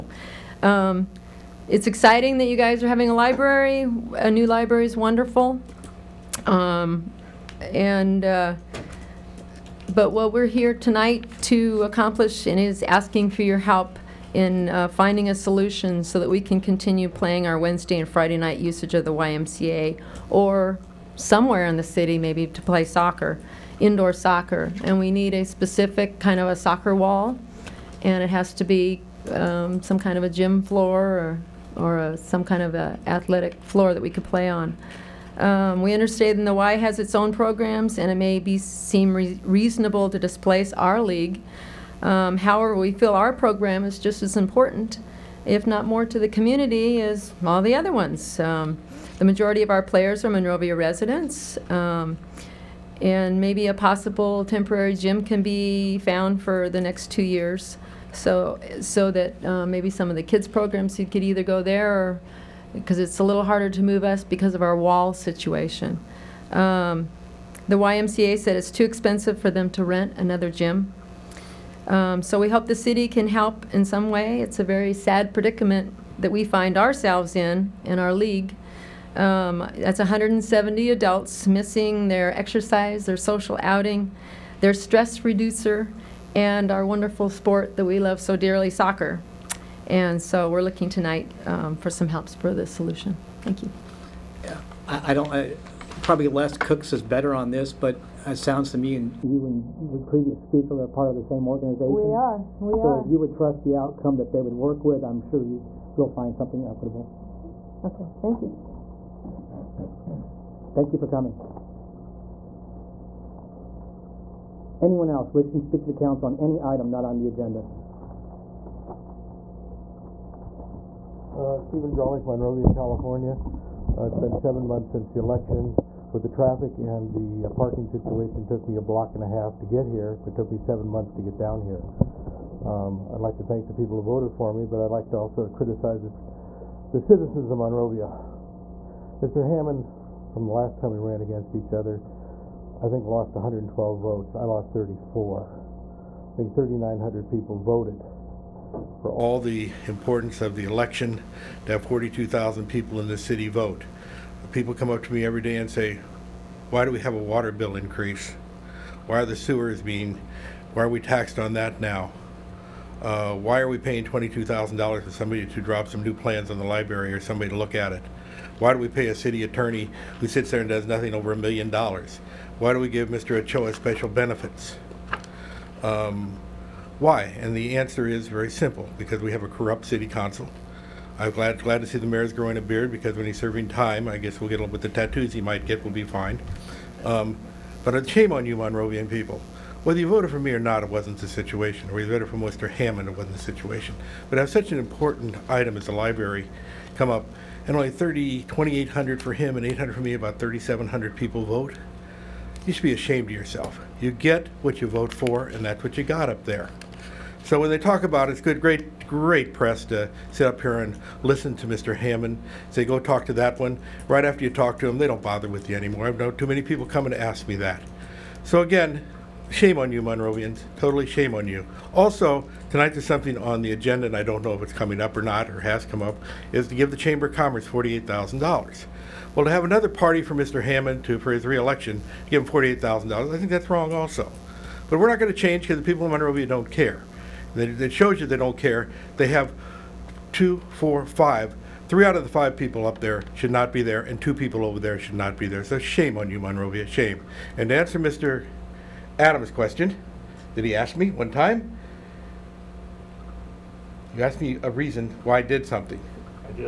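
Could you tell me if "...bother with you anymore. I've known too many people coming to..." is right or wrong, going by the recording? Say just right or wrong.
right.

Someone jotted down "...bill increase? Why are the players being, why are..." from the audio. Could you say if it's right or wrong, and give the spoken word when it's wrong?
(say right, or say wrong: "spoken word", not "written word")
wrong: "sewers", not "players".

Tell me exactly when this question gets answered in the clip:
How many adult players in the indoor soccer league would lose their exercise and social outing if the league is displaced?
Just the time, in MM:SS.
01:19.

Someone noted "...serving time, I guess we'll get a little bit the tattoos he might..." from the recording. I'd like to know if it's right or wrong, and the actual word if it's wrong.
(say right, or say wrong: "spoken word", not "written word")
right.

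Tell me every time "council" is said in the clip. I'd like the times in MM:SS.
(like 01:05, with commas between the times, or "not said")
01:55, 03:00.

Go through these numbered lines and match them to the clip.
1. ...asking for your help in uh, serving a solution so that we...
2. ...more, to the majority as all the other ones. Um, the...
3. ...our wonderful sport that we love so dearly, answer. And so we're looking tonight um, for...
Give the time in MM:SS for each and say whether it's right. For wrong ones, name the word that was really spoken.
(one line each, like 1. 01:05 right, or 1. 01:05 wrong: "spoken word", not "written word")
1. 00:12 wrong: "finding", not "serving"
2. 00:45 wrong: "community", not "majority"
3. 01:26 wrong: "soccer", not "answer".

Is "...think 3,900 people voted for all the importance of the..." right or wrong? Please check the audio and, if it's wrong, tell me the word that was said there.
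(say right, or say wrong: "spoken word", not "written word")
right.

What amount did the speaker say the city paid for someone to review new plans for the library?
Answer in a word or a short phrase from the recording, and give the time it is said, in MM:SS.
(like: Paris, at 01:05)
$22,000, at 02:44.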